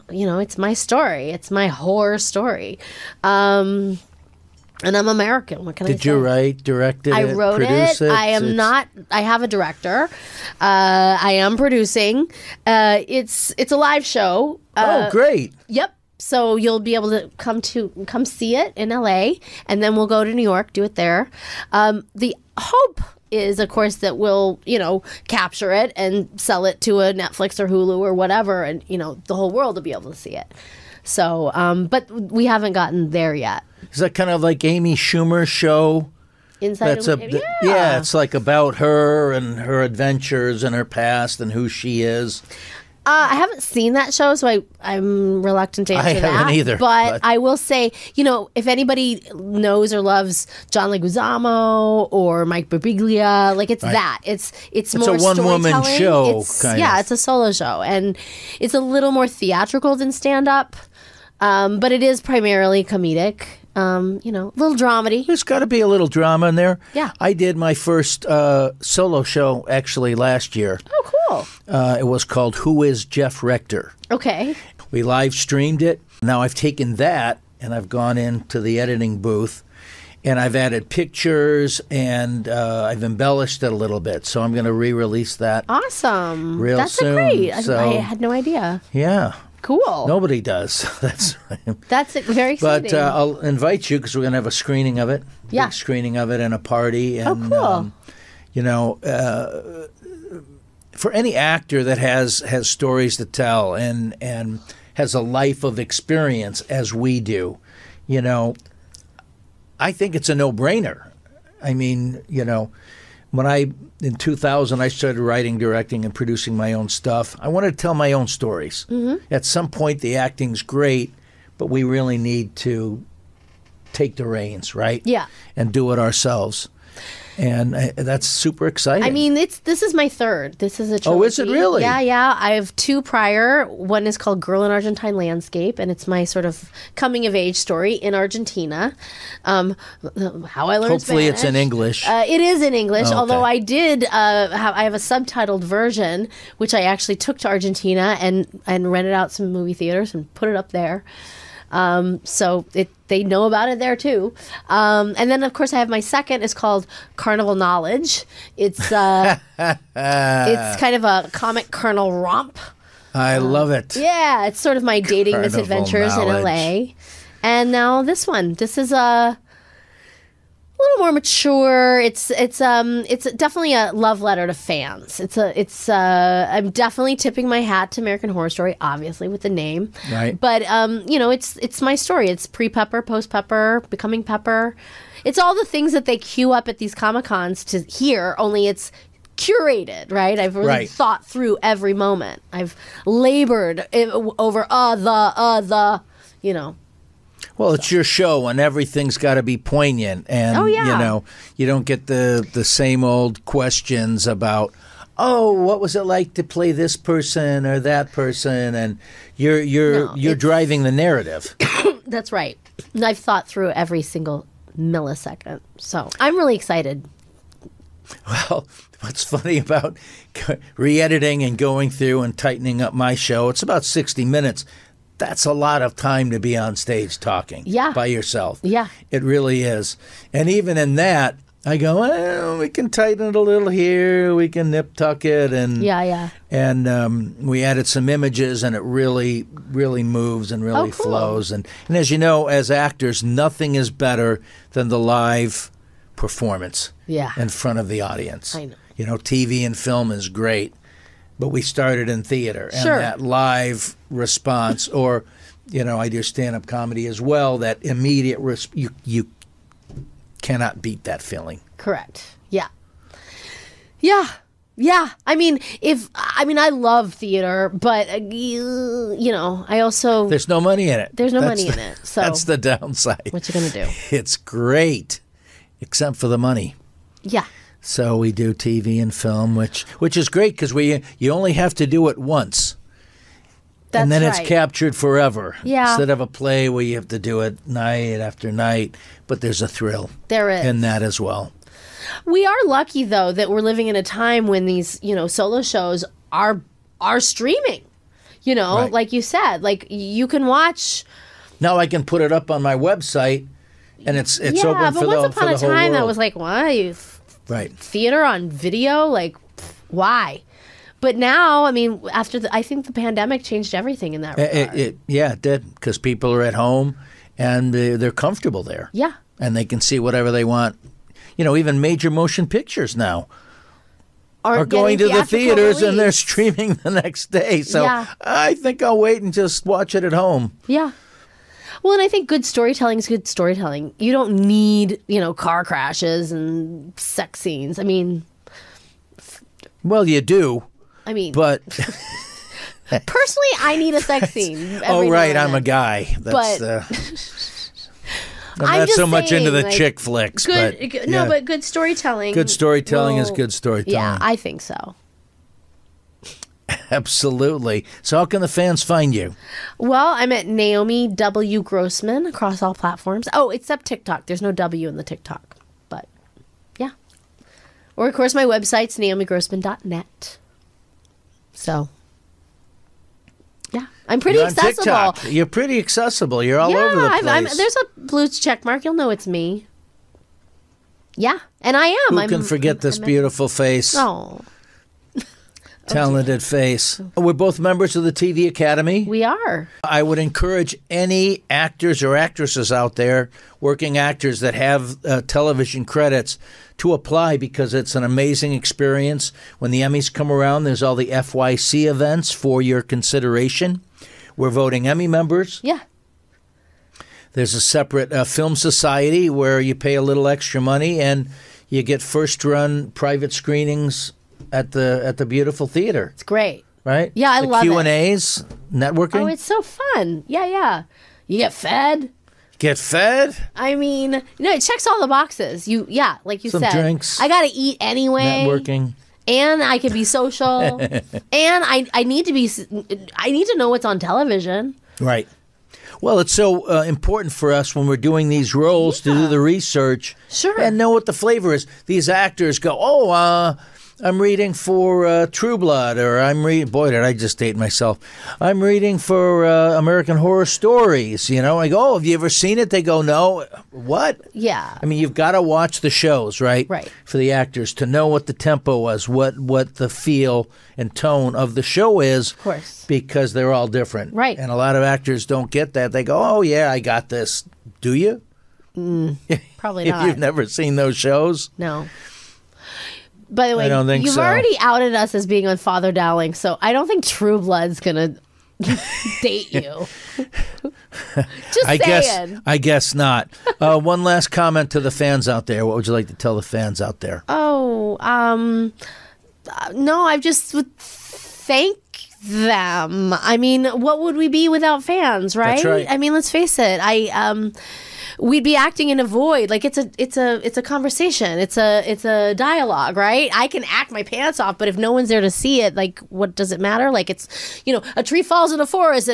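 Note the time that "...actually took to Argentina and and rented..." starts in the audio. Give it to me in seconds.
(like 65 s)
146 s.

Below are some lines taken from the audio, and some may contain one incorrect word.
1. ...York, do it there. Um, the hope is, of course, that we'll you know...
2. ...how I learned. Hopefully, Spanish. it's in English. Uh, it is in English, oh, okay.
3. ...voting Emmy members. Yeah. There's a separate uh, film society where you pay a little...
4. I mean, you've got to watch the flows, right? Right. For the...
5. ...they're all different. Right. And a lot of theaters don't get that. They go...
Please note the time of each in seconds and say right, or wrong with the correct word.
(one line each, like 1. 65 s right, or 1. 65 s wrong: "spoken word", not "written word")
1. 20 s right
2. 140 s right
3. 404 s right
4. 454 s wrong: "shows", not "flows"
5. 463 s wrong: "actors", not "theaters".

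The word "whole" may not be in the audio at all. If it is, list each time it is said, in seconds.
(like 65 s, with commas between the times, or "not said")
29 s, 304 s.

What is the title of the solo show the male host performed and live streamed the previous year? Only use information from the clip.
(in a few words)
Who is Jeff Rector?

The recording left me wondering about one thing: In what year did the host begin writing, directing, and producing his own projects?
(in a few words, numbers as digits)
2000.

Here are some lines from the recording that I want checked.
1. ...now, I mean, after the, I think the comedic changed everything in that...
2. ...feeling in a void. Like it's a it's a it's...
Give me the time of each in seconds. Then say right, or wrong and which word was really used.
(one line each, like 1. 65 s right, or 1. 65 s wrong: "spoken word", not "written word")
1. 311 s wrong: "pandemic", not "comedic"
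2. 498 s wrong: "acting", not "feeling".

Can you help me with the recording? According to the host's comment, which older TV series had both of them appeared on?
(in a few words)
Father Dowling.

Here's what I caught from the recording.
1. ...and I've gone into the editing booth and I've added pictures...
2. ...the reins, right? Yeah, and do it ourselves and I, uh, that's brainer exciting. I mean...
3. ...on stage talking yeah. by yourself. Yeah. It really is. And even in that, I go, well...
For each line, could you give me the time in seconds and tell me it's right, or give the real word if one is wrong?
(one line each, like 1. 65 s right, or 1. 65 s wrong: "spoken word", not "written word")
1. 77 s right
2. 124 s wrong: "super", not "brainer"
3. 226 s right.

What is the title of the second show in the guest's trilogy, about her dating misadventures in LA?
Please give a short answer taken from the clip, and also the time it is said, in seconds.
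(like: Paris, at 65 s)
Carnal Knowledge, at 157 s.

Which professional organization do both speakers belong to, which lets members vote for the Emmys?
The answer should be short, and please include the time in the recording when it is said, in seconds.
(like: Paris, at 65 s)
TV Academy, at 388 s.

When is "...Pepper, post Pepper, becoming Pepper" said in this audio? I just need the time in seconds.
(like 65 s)
182 s.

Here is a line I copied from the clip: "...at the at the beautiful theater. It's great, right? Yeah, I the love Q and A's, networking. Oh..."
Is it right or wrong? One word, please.
right.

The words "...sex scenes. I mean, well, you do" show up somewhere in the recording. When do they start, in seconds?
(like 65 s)
336 s.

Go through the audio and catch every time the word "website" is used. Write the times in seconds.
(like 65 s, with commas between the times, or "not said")
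302 s, 368 s.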